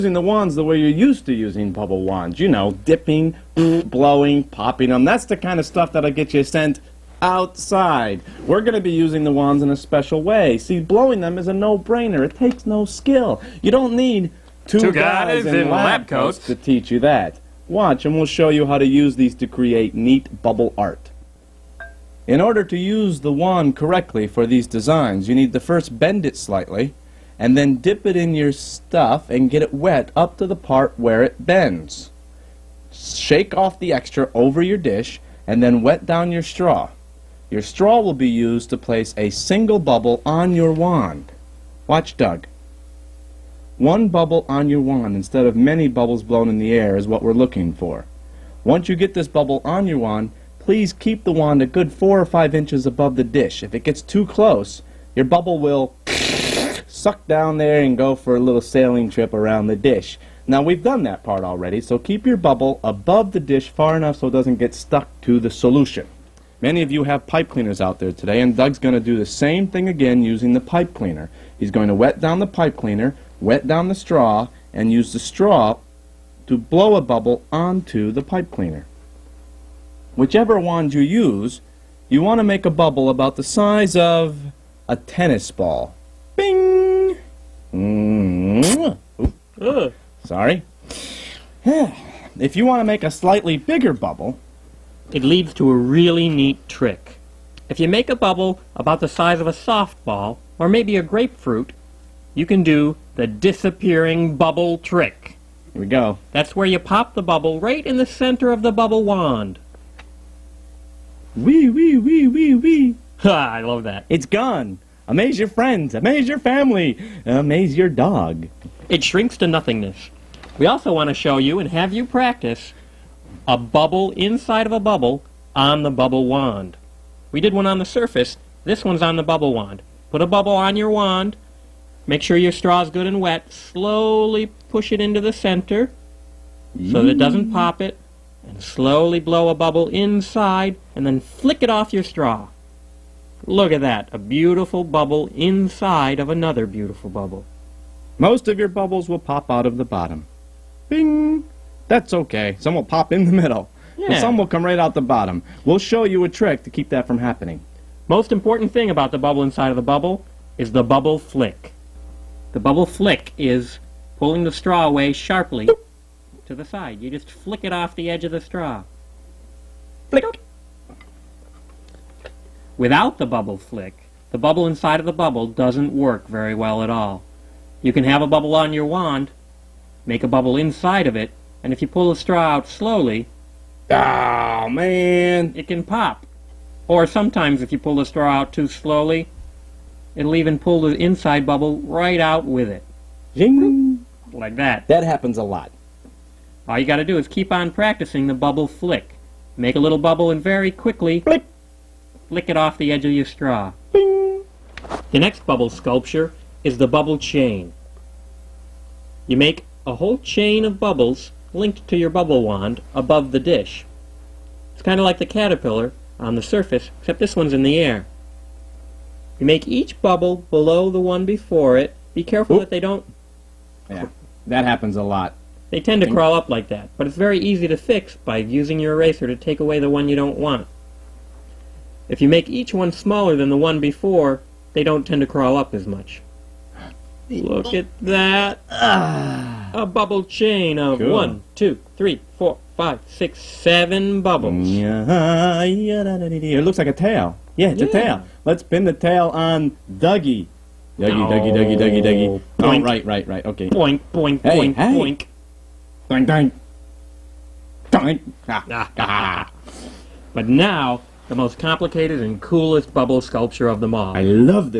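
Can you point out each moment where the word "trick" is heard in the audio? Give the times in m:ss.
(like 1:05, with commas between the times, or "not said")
1:36, 1:44, 2:36.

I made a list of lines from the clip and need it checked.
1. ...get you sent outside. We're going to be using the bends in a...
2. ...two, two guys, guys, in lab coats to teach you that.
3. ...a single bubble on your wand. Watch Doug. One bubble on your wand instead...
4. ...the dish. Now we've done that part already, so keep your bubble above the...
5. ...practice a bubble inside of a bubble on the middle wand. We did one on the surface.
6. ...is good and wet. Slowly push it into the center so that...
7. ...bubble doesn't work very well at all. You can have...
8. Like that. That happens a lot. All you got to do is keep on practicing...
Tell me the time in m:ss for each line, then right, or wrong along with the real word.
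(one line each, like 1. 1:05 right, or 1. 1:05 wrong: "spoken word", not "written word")
1. 0:06 wrong: "wands", not "bends"
2. 0:14 right
3. 0:39 right
4. 0:59 right
5. 2:02 wrong: "bubble", not "middle"
6. 2:12 right
7. 2:55 right
8. 3:14 right.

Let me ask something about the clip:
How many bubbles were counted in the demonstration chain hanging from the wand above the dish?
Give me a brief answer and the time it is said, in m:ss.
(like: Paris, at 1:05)
7, at 4:03.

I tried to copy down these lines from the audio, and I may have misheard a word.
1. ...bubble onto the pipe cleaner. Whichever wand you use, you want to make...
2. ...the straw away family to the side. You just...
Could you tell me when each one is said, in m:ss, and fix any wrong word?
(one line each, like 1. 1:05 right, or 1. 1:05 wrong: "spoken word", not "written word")
1. 1:17 right
2. 2:44 wrong: "sharply", not "family".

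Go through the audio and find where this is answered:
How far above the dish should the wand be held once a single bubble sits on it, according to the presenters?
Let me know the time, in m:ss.
0:51.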